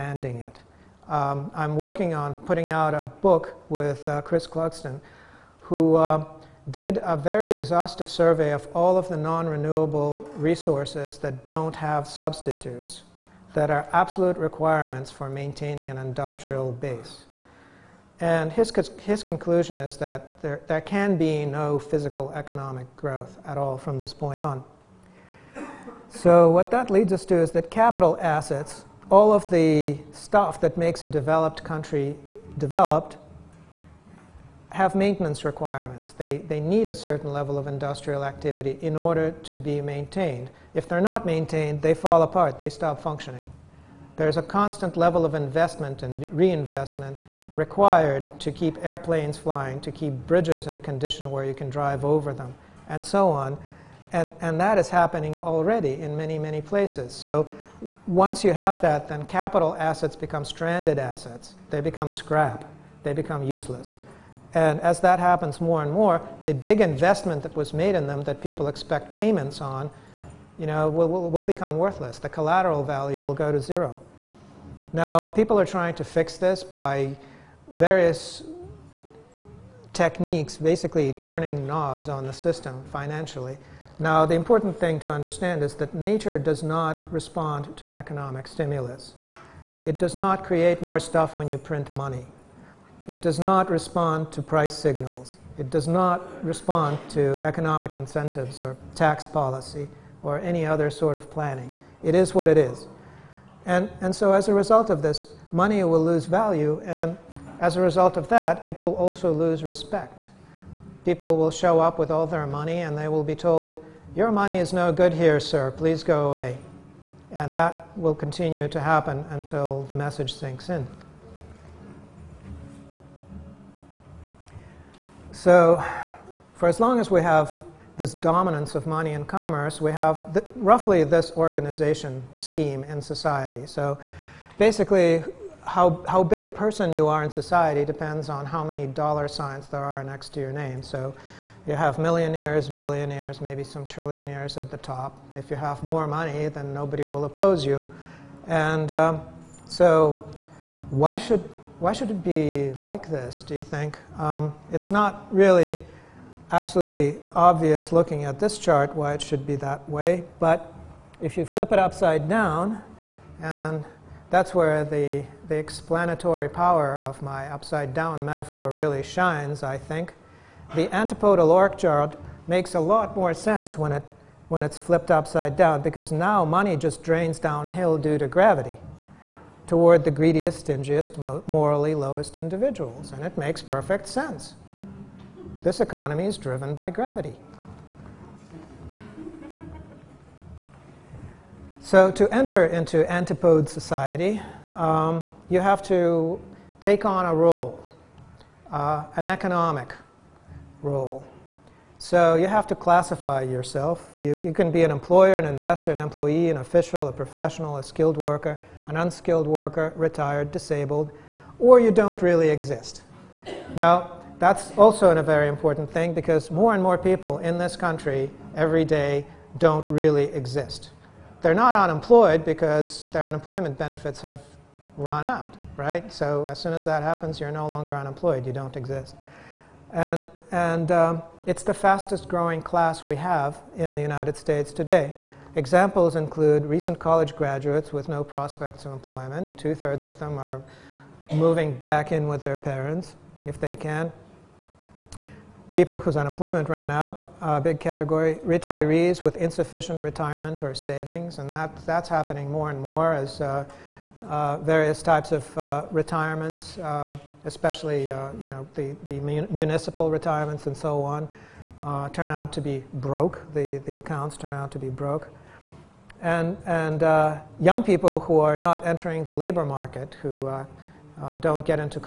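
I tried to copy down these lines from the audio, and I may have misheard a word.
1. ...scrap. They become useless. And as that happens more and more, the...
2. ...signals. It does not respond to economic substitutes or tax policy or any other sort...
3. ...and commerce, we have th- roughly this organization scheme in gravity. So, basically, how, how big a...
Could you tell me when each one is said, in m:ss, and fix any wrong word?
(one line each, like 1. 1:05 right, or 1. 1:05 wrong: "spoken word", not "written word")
1. 1:02 right
2. 1:34 wrong: "incentives", not "substitutes"
3. 2:09 wrong: "society", not "gravity".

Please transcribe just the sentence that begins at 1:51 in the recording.
People will show up with all their money and they will be told, your money is no good here, sir.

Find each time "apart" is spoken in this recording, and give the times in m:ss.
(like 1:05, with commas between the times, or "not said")
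0:42.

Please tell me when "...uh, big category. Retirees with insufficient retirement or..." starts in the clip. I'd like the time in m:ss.
4:07.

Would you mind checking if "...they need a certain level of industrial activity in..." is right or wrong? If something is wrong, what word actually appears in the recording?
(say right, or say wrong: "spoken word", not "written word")
right.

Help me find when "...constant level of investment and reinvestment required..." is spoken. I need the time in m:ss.
0:44.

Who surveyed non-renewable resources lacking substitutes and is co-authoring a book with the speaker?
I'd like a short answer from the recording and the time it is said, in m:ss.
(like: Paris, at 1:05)
Chris Clugston, at 0:04.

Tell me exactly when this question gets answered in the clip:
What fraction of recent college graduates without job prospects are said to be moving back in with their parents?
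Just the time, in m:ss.
3:59.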